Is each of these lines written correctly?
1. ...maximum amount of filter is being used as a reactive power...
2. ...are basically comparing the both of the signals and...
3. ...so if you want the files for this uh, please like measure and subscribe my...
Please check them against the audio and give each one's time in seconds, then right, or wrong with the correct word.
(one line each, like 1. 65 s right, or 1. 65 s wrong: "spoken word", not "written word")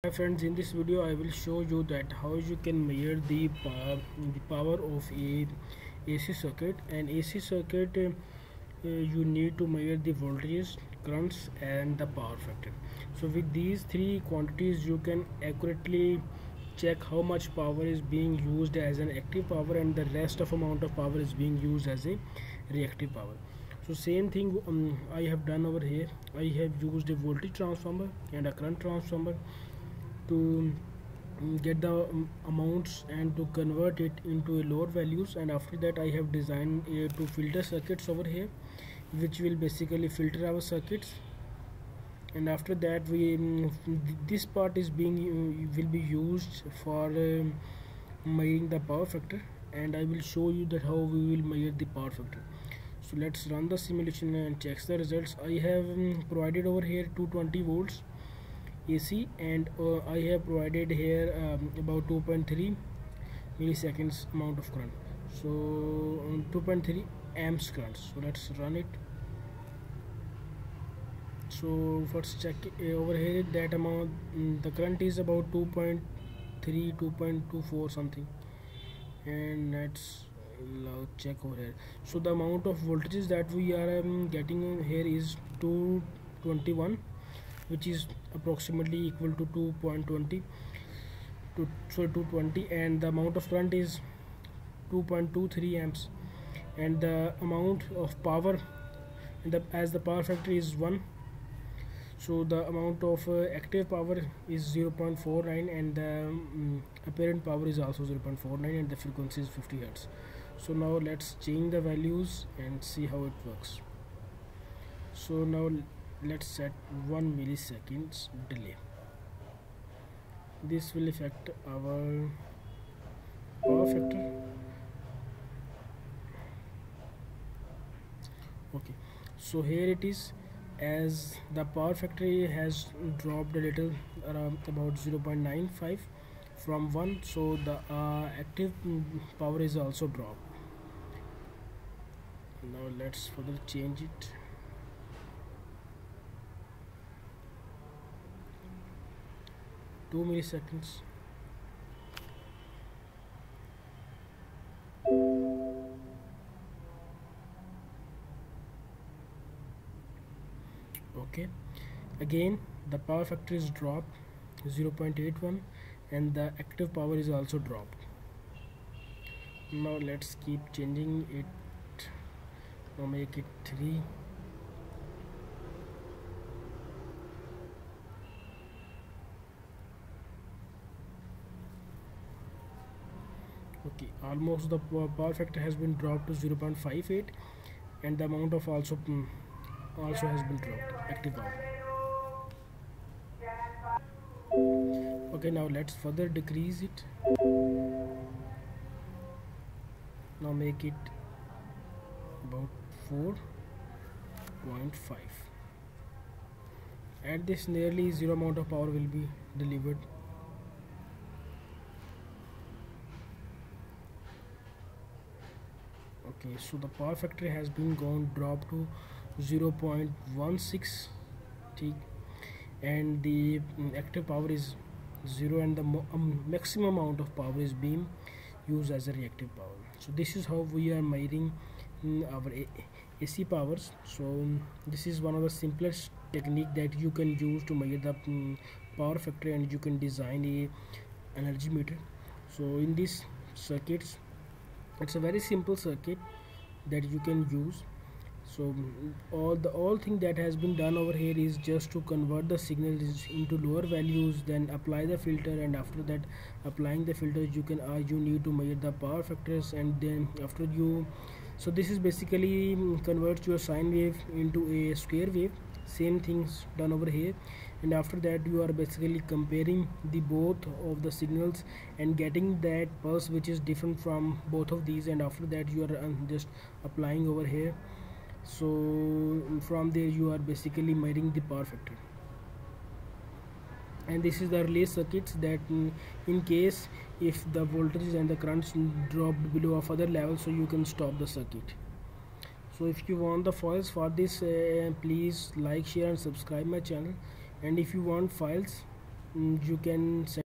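1. 226 s wrong: "power", not "filter"
2. 268 s right
3. 292 s wrong: "share", not "measure".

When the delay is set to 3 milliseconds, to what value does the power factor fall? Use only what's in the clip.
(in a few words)
0.58.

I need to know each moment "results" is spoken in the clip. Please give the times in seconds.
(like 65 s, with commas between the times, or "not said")
55 s.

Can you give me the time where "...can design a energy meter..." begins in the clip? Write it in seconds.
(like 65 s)
239 s.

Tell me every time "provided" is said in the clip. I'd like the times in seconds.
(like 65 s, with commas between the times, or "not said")
56 s, 60 s.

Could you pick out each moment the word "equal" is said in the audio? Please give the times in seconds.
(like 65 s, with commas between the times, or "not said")
89 s.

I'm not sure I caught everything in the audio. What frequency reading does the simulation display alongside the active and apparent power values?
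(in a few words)
50 hertz.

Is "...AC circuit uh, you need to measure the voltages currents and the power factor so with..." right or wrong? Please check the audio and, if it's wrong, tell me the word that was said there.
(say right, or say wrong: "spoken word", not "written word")
right.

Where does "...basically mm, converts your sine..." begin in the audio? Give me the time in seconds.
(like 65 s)
261 s.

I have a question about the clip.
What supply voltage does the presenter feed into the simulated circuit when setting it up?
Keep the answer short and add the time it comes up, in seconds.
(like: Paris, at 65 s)
220 volts AC, at 57 s.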